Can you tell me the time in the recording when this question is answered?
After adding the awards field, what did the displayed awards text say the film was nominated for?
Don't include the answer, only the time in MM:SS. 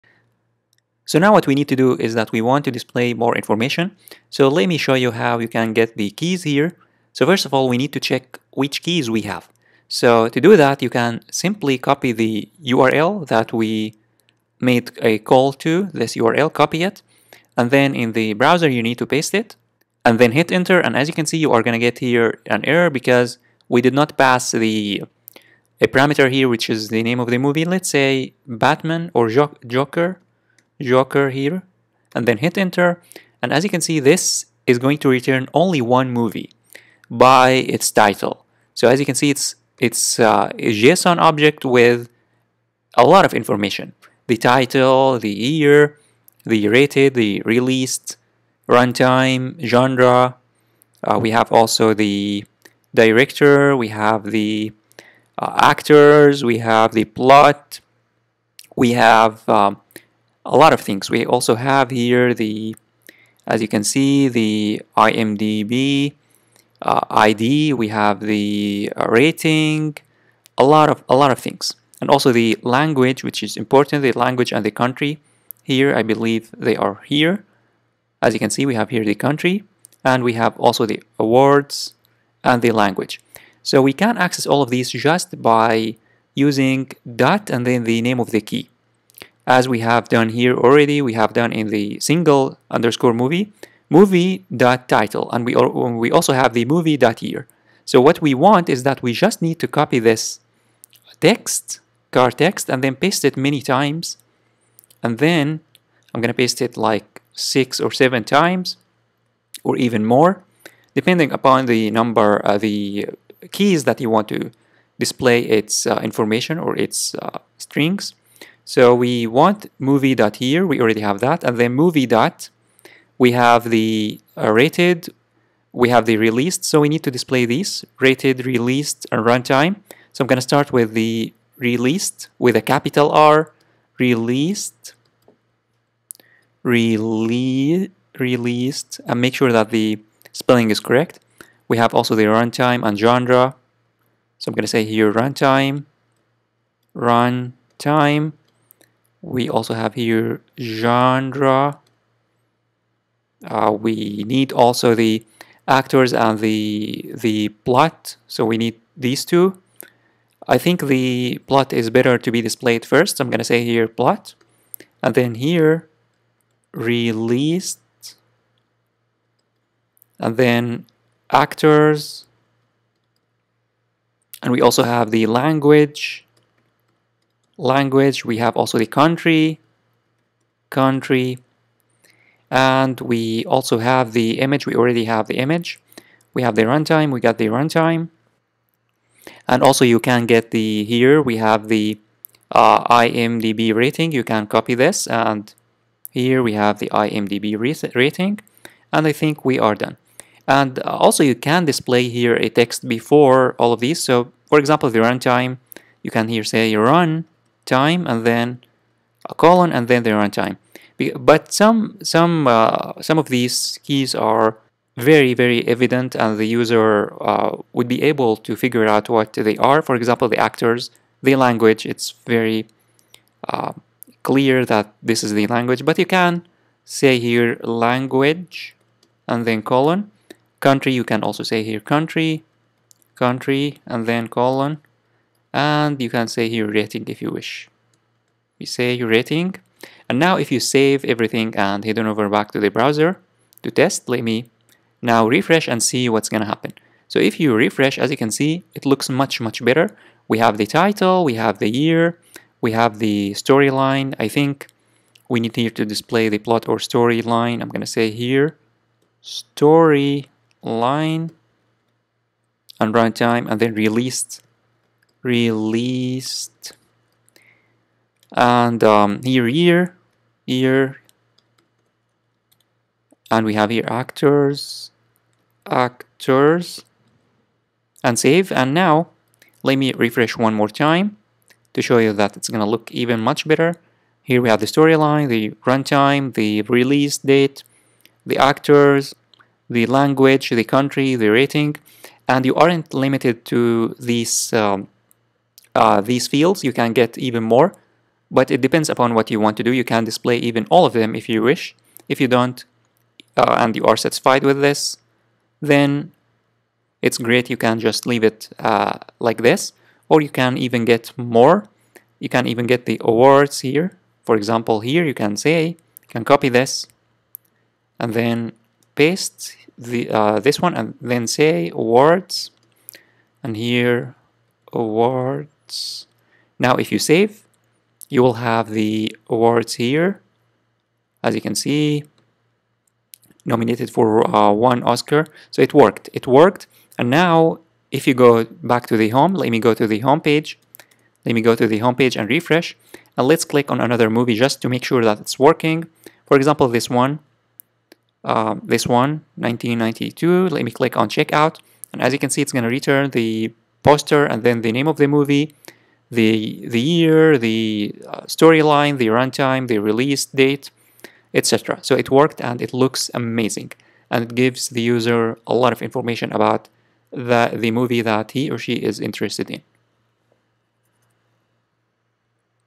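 05:34.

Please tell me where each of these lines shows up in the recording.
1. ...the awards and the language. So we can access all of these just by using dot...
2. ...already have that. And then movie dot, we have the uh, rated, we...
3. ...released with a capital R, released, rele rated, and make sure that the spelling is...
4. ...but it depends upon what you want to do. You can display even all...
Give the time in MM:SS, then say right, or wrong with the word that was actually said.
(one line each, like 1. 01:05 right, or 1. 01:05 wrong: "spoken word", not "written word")
1. 01:20 right
2. 02:00 right
3. 02:11 wrong: "released", not "rated"
4. 04:58 right.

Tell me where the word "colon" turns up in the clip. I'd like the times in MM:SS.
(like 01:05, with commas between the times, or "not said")
03:29, 03:49, 03:54.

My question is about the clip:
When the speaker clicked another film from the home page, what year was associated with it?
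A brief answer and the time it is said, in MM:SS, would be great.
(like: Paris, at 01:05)
1992, at 05:49.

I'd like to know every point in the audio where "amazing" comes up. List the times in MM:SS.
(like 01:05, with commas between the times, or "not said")
06:03.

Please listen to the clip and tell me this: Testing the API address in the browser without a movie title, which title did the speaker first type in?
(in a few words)
Joker.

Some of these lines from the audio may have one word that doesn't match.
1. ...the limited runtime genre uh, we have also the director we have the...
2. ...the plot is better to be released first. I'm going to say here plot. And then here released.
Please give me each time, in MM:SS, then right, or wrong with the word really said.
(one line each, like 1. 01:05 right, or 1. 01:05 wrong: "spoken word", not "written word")
1. 00:47 wrong: "released", not "limited"
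2. 02:40 wrong: "displayed", not "released".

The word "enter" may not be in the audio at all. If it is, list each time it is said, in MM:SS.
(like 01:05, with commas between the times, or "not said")
00:20, 00:32.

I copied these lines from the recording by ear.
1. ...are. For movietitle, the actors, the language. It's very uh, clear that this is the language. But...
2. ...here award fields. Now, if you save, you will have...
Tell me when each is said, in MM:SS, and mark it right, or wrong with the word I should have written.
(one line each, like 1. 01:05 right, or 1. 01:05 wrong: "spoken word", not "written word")
1. 03:39 wrong: "example", not "movietitle"
2. 05:23 wrong: "awards", not "fields".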